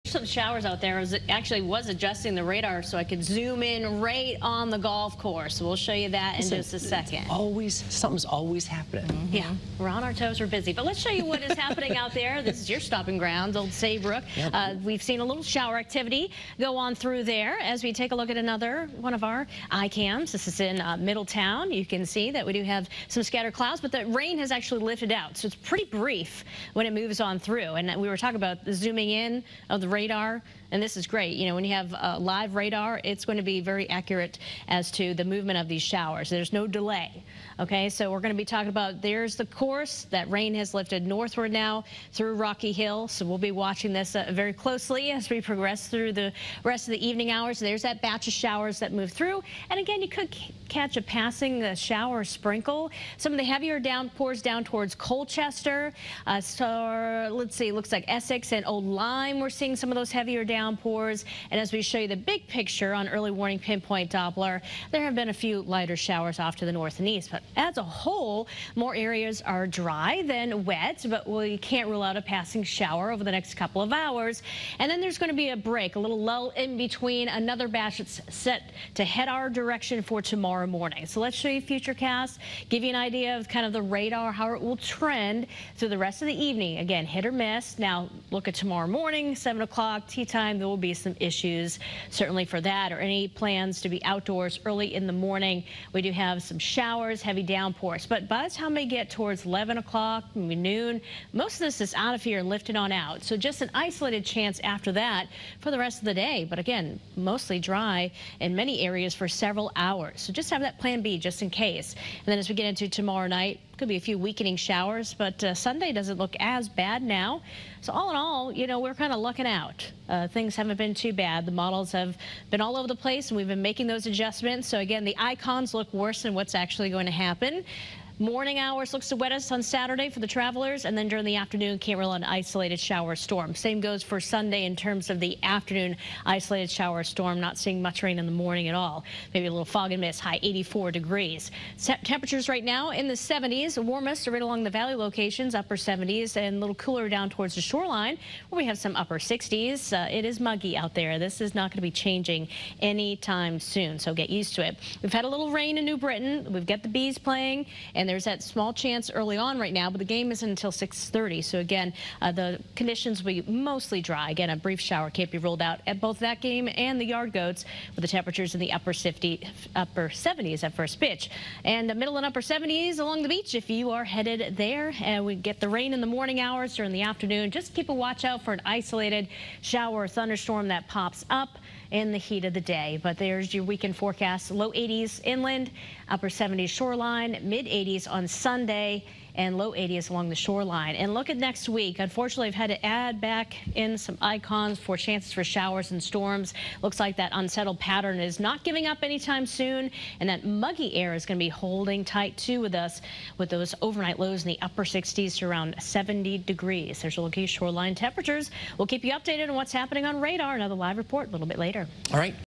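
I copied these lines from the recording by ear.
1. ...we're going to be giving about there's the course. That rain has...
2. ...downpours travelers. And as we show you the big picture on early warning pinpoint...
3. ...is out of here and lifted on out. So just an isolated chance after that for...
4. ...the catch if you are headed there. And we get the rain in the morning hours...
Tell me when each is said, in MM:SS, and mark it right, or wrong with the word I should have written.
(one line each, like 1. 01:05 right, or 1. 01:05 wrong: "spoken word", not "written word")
1. 00:38 wrong: "talking", not "giving"
2. 01:00 wrong: "downpours", not "travelers"
3. 01:41 right
4. 02:53 wrong: "beach", not "catch".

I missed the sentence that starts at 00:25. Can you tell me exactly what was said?
So it's pretty brief when it moves on through.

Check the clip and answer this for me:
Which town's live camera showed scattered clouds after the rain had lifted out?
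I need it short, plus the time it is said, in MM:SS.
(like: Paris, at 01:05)
Middletown, at 00:20.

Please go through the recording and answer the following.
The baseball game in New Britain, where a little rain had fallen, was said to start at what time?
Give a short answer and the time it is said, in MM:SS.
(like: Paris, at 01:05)
6:30, at 02:40.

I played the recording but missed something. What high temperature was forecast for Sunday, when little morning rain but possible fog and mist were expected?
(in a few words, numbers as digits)
84 degrees.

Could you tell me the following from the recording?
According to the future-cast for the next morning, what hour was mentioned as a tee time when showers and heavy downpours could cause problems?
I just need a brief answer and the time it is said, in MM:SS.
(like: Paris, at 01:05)
7 o'clock, at 01:29.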